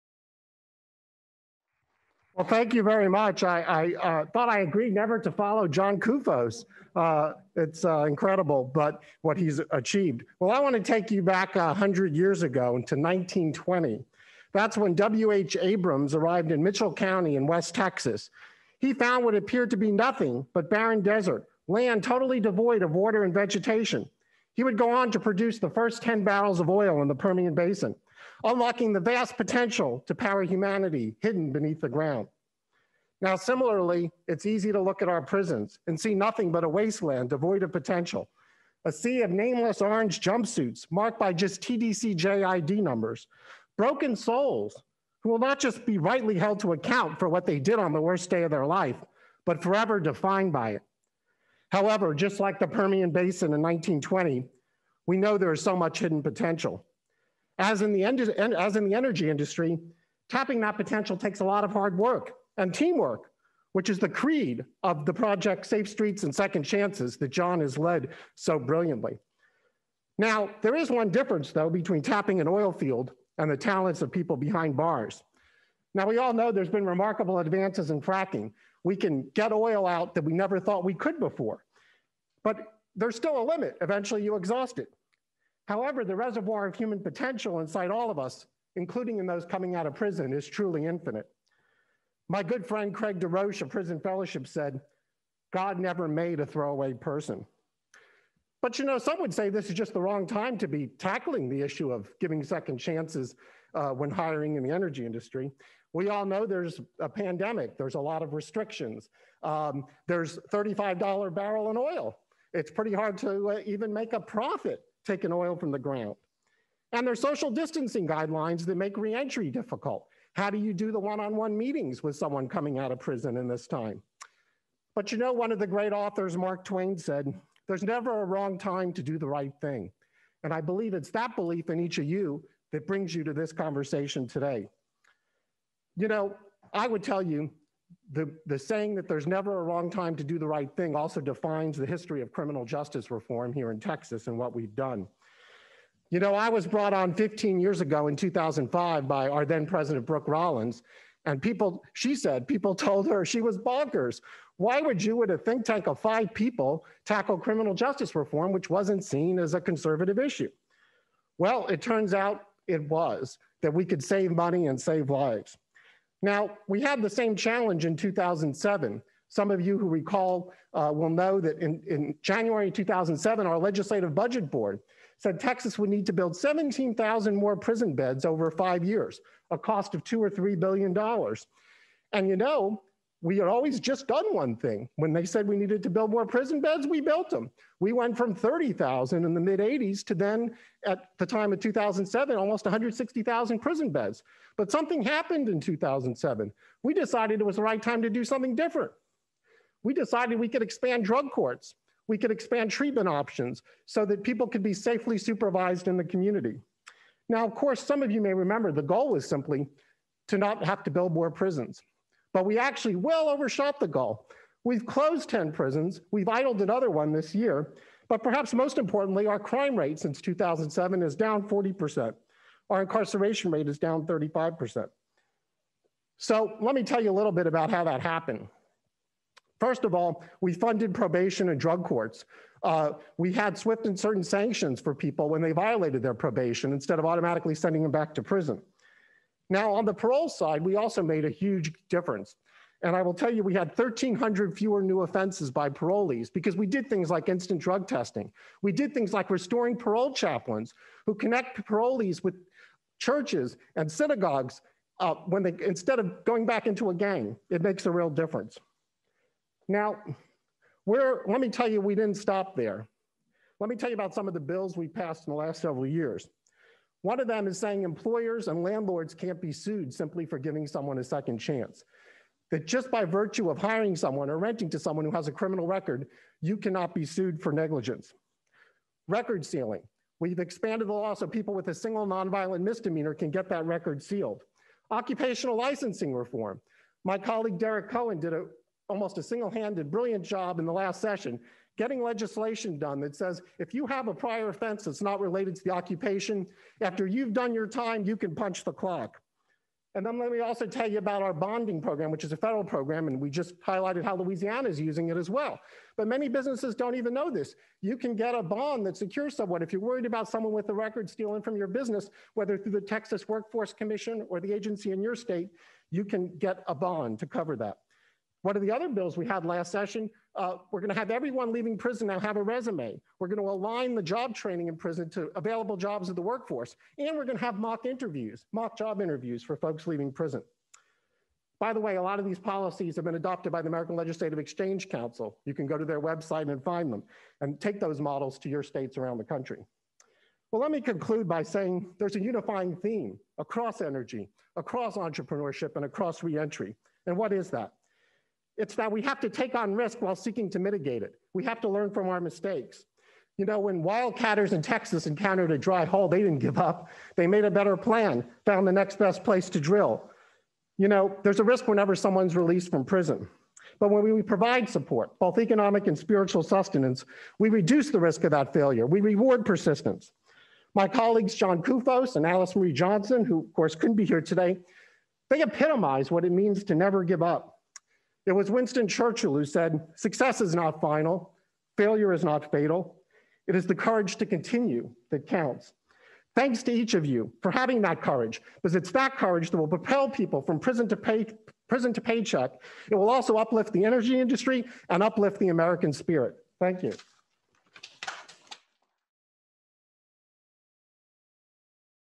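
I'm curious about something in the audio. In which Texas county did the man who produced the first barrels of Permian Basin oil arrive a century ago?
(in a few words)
Mitchell County.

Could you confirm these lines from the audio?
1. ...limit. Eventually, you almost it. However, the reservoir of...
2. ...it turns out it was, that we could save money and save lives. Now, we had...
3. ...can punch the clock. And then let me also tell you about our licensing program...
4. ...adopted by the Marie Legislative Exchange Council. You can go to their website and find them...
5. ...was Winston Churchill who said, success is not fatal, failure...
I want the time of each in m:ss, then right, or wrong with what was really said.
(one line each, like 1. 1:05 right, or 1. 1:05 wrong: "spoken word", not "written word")
1. 1:23 wrong: "exhaust", not "almost"
2. 2:41 right
3. 4:58 wrong: "bonding", not "licensing"
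4. 5:33 wrong: "American", not "Marie"
5. 6:18 wrong: "final", not "fatal".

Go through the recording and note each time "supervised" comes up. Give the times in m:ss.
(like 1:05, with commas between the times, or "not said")
3:25.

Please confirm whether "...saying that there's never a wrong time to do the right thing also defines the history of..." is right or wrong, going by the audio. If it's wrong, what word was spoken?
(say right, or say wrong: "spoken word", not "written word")
right.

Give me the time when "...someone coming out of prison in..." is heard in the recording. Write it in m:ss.
2:02.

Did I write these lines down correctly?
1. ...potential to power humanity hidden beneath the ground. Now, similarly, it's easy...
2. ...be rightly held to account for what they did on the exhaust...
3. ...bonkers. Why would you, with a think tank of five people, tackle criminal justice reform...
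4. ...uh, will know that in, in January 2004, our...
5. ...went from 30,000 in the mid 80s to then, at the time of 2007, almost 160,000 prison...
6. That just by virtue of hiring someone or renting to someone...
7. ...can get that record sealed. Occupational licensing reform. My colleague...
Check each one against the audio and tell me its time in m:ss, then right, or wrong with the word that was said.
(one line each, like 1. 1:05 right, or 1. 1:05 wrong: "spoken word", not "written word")
1. 0:29 right
2. 0:45 wrong: "worst", not "exhaust"
3. 2:33 right
4. 2:50 wrong: "2007", not "2004"
5. 3:07 right
6. 4:32 right
7. 4:43 right.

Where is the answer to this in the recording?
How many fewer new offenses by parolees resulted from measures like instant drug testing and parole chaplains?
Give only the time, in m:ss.
4:03.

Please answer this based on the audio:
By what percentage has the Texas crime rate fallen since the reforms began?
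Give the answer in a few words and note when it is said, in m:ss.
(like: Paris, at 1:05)
40%, at 3:41.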